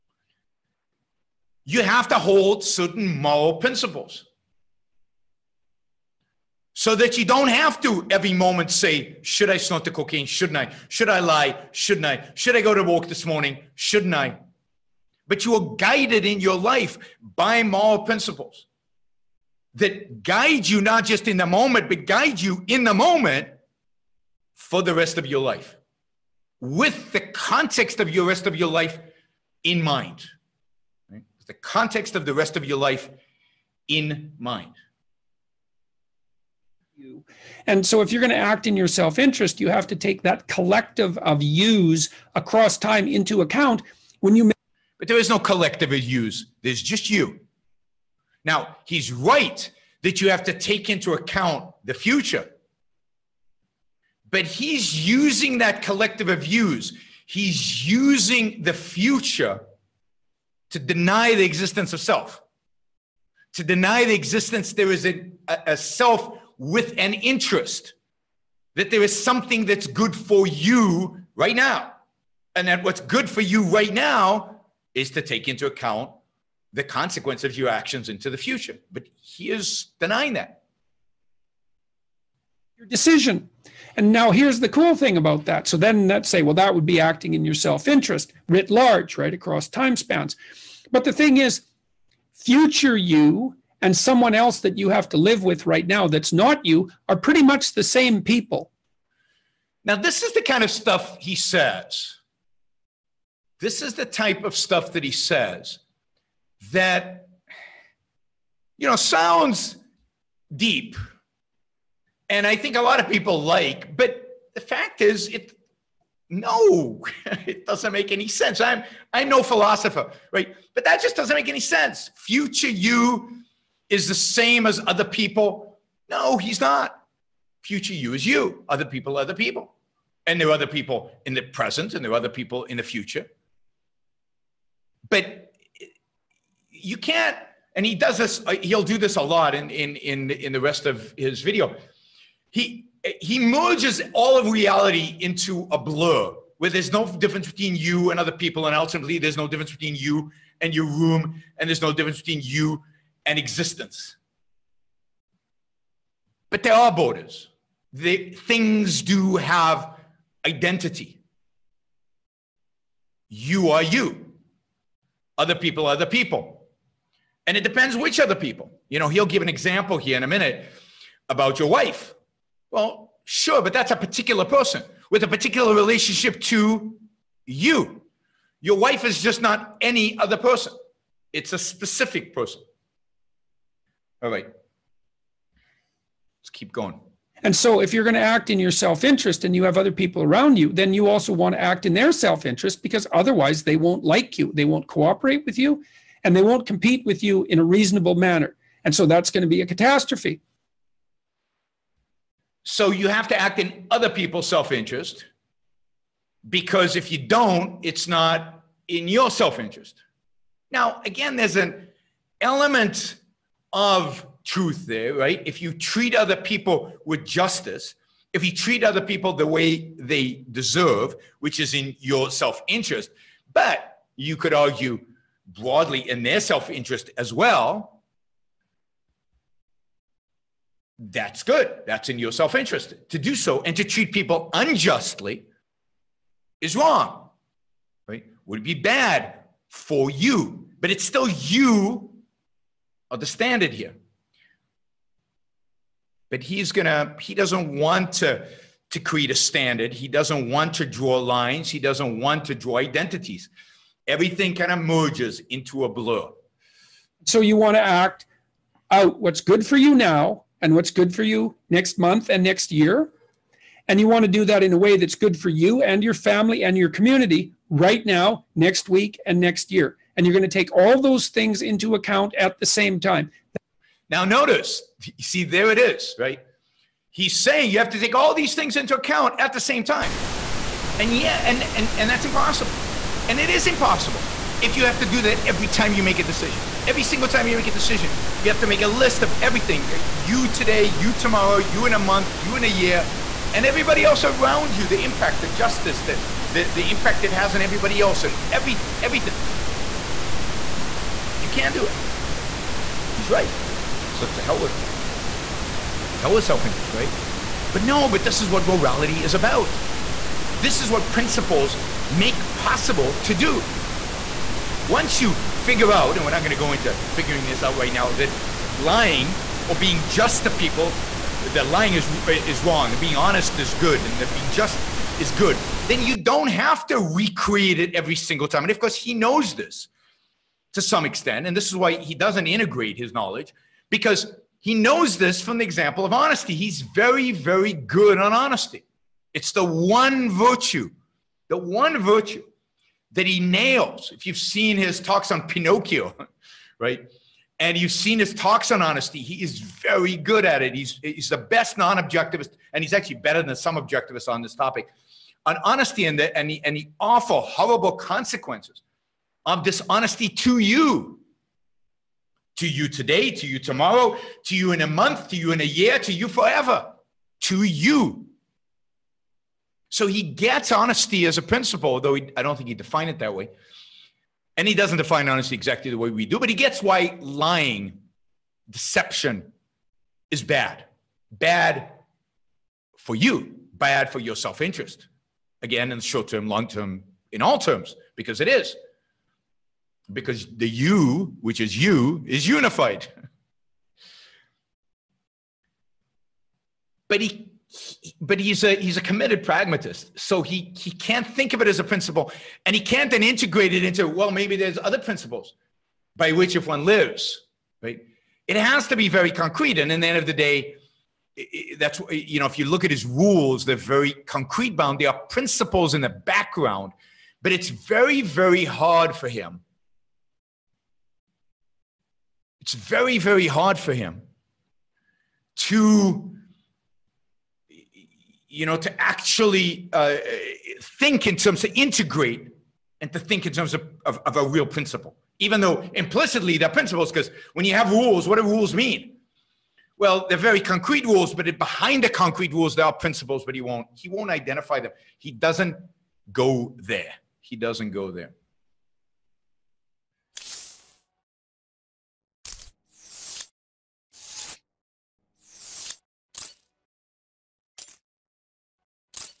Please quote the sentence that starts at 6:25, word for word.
Again, in short term, long term, in all terms, because it is.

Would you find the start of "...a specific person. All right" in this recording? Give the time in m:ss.
3:01.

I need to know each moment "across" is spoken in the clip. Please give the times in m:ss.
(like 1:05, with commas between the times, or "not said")
0:42, 1:29.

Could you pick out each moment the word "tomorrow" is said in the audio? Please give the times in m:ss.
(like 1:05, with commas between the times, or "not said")
4:51, 6:03.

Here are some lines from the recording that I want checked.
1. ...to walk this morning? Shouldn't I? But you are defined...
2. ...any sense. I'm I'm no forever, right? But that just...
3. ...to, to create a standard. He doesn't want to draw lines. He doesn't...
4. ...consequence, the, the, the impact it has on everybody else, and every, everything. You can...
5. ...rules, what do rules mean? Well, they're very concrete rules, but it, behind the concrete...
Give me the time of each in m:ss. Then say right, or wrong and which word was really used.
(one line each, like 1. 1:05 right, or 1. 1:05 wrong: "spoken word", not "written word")
1. 0:12 wrong: "guided", not "defined"
2. 1:58 wrong: "philosopher", not "forever"
3. 4:08 right
4. 4:55 wrong: "justice", not "consequence"
5. 7:17 right.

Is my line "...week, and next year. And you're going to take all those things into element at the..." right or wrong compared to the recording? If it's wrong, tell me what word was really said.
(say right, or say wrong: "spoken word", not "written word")
wrong: "account", not "element".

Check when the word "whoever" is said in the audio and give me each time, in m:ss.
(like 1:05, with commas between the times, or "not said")
not said.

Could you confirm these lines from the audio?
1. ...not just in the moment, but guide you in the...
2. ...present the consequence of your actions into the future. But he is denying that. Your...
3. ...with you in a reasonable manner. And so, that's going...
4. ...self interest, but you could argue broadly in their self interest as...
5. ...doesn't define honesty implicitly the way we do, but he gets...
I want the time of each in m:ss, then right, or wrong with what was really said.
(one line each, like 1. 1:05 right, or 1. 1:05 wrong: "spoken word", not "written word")
1. 0:20 right
2. 1:15 wrong: "account", not "present"
3. 3:17 right
4. 3:42 right
5. 6:14 wrong: "exactly", not "implicitly".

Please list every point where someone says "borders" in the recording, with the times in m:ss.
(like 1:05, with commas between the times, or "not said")
2:36.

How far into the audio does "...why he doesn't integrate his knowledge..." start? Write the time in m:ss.
5:31.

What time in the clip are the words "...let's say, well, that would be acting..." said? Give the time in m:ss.
1:26.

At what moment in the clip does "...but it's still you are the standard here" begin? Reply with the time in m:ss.
4:00.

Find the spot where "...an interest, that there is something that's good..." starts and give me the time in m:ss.
1:06.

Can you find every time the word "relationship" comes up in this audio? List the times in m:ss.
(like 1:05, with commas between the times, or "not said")
2:55.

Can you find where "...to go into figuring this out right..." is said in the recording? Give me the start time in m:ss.
5:16.